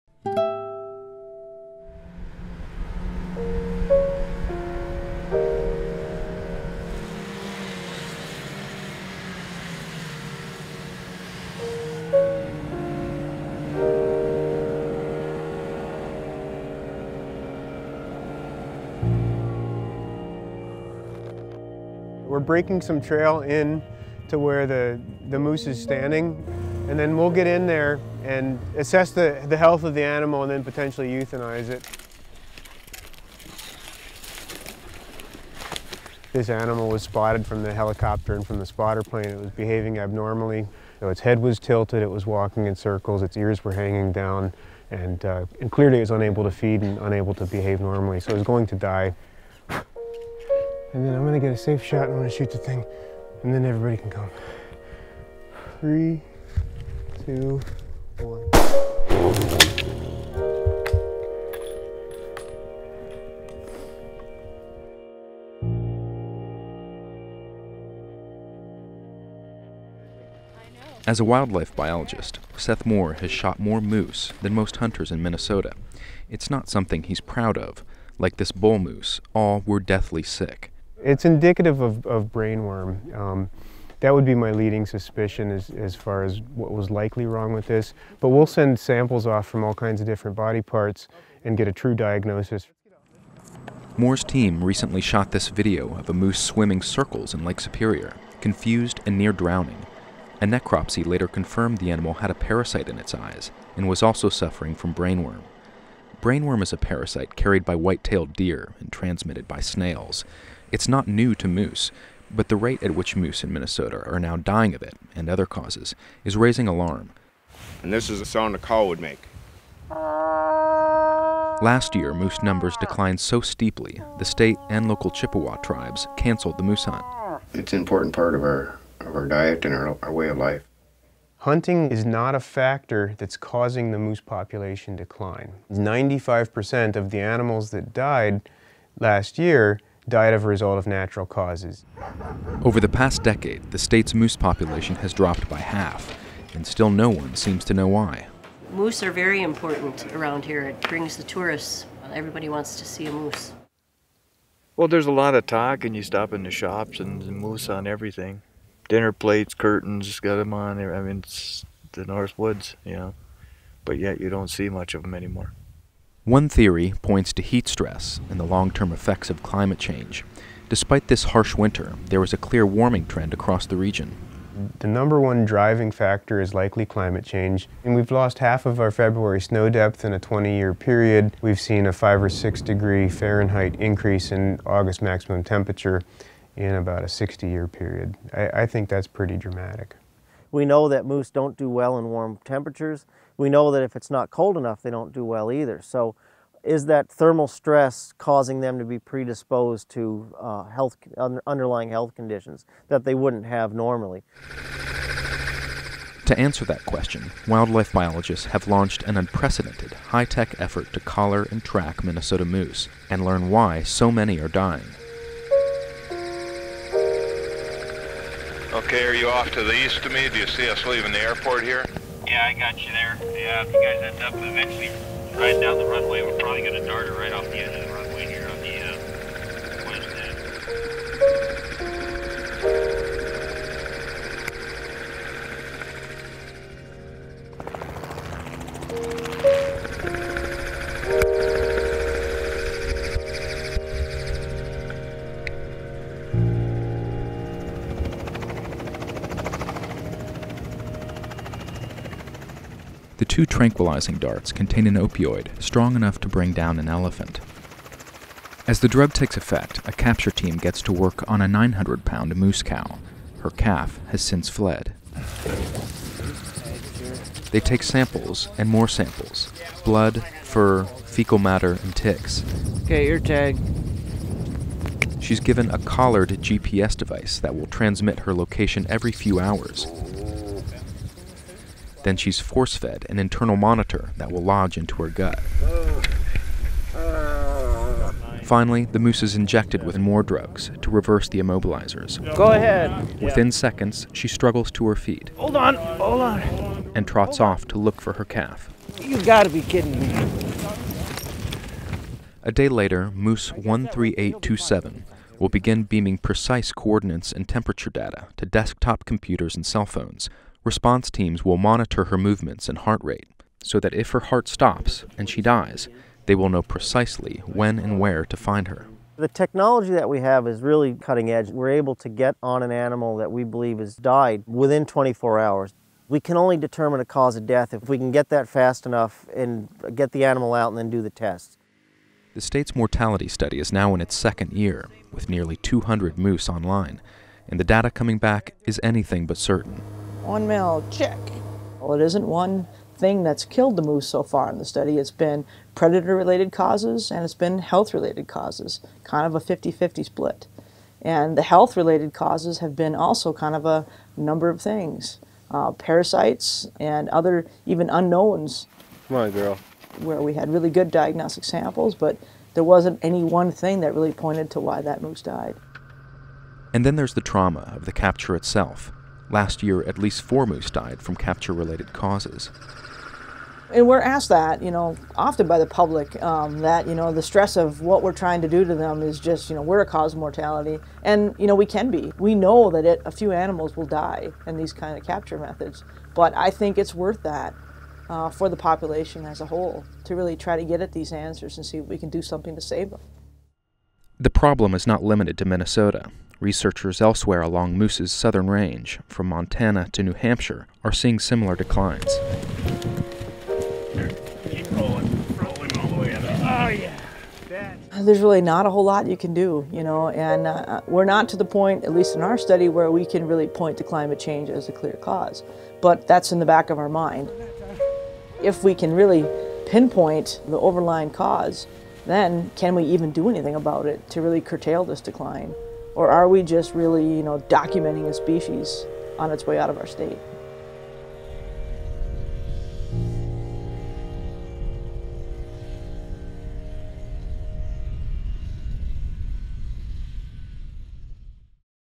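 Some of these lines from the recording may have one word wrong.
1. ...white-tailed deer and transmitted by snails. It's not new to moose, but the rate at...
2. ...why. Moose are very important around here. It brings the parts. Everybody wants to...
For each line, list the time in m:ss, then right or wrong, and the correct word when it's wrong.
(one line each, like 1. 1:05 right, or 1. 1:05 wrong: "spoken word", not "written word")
1. 1:47 right
2. 2:27 wrong: "tourists", not "parts".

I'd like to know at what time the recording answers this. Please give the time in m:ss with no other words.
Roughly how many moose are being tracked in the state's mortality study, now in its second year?
5:35.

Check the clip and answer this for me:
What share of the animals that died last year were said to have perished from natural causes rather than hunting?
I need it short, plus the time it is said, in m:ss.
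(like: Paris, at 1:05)
95%, at 2:15.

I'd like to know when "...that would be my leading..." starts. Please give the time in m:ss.
1:24.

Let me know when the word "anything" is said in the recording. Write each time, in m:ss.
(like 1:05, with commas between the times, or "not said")
5:38, 7:03.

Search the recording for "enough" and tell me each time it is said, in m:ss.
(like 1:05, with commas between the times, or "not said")
3:14, 4:15, 5:28.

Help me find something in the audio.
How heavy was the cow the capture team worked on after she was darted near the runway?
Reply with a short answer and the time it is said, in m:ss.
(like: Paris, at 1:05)
900 pounds, at 4:21.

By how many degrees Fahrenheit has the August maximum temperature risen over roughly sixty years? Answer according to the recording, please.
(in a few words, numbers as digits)
5 or 6 degrees.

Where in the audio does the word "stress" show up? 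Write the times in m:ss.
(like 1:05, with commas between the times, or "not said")
2:47, 3:17, 6:17.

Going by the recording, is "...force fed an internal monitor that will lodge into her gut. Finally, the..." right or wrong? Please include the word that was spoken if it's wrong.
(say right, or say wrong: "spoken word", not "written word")
right.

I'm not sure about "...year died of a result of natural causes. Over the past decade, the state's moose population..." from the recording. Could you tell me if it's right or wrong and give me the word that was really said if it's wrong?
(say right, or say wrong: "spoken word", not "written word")
right.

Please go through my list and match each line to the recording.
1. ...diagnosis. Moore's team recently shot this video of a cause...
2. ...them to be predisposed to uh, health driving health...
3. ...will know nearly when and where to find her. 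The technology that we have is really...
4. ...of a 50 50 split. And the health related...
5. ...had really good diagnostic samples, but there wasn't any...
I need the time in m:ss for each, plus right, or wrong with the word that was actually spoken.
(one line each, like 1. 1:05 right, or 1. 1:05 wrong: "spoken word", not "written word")
1. 1:31 wrong: "moose", not "cause"
2. 3:18 wrong: "underlying", not "driving"
3. 5:16 wrong: "precisely", not "nearly"
4. 5:49 right
5. 6:00 right.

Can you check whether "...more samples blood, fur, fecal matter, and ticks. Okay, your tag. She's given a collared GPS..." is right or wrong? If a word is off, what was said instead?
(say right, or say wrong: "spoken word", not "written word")
right.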